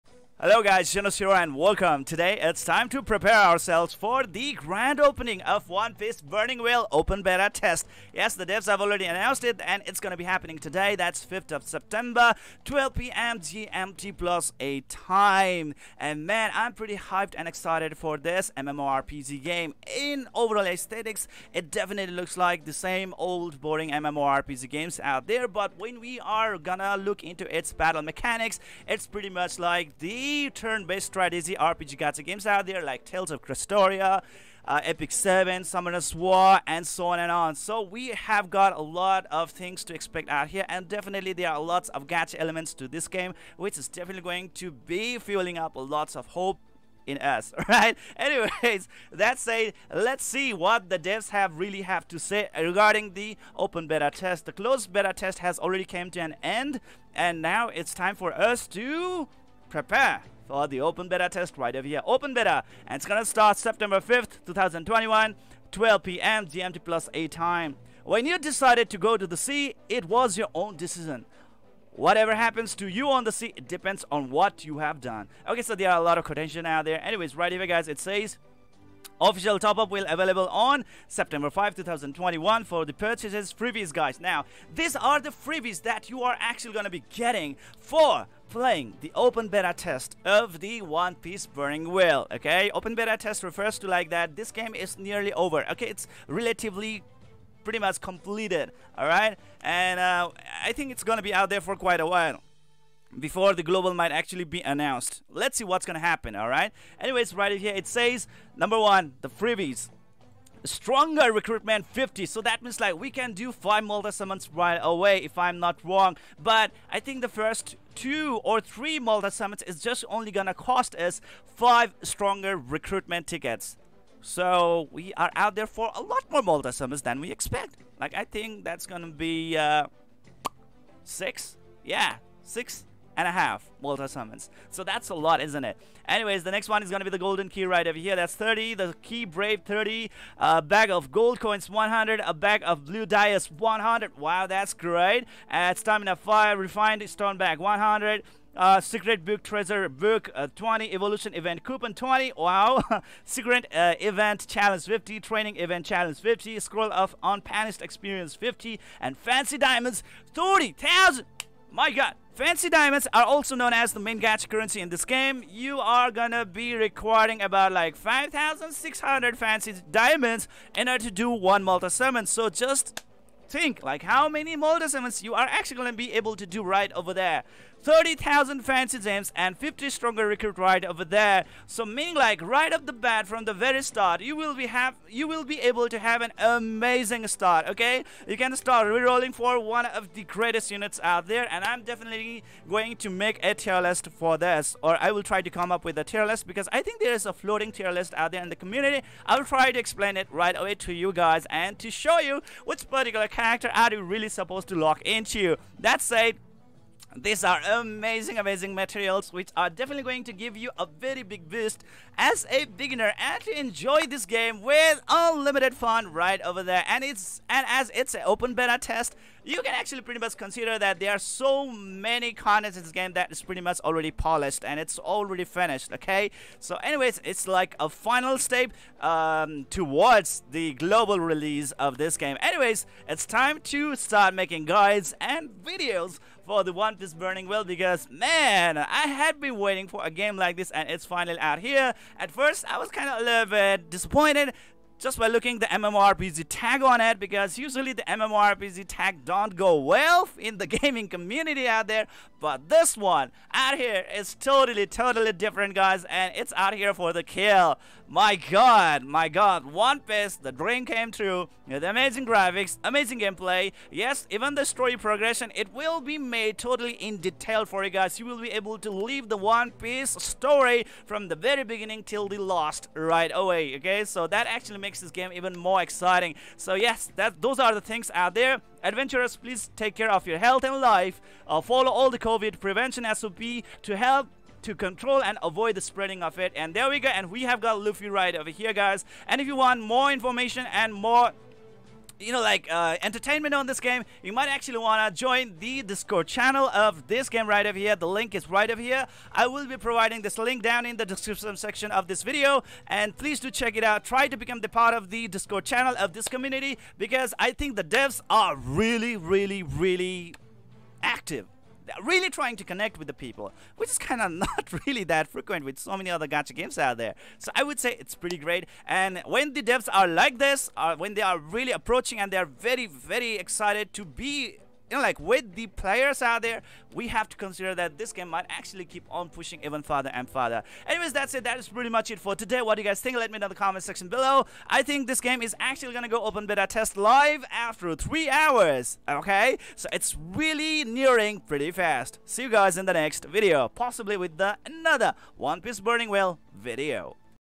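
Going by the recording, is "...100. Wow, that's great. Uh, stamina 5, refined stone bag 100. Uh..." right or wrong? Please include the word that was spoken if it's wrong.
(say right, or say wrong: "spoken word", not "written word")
right.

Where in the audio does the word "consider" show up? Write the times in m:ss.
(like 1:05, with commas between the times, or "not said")
3:40, 5:27.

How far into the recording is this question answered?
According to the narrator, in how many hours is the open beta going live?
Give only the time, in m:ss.
5:37.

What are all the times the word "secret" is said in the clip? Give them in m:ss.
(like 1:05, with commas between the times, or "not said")
2:28, 2:33.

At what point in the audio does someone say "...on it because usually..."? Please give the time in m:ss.
4:06.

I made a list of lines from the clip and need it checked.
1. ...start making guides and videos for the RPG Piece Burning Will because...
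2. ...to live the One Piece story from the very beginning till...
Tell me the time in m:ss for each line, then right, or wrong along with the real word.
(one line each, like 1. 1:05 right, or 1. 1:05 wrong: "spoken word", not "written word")
1. 3:53 wrong: "One", not "RPG"
2. 4:28 right.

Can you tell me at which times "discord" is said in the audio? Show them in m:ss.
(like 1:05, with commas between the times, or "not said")
4:55, 5:05.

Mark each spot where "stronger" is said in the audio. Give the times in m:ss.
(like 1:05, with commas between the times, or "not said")
1:50, 2:02, 2:59.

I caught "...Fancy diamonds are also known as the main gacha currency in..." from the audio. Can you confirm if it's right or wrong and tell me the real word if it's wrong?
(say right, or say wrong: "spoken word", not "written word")
right.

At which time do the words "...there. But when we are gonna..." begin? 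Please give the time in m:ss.
0:25.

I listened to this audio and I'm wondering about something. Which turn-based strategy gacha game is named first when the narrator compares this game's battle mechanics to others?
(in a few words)
Tales of Crestoria.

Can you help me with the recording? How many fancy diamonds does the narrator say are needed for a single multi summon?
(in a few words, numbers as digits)
5,600.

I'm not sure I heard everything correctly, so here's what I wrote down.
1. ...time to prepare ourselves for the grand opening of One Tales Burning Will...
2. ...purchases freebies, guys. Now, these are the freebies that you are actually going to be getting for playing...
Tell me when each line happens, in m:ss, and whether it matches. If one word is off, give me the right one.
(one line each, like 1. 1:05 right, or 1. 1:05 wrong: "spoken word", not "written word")
1. 0:02 wrong: "Piece", not "Tales"
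2. 1:22 right.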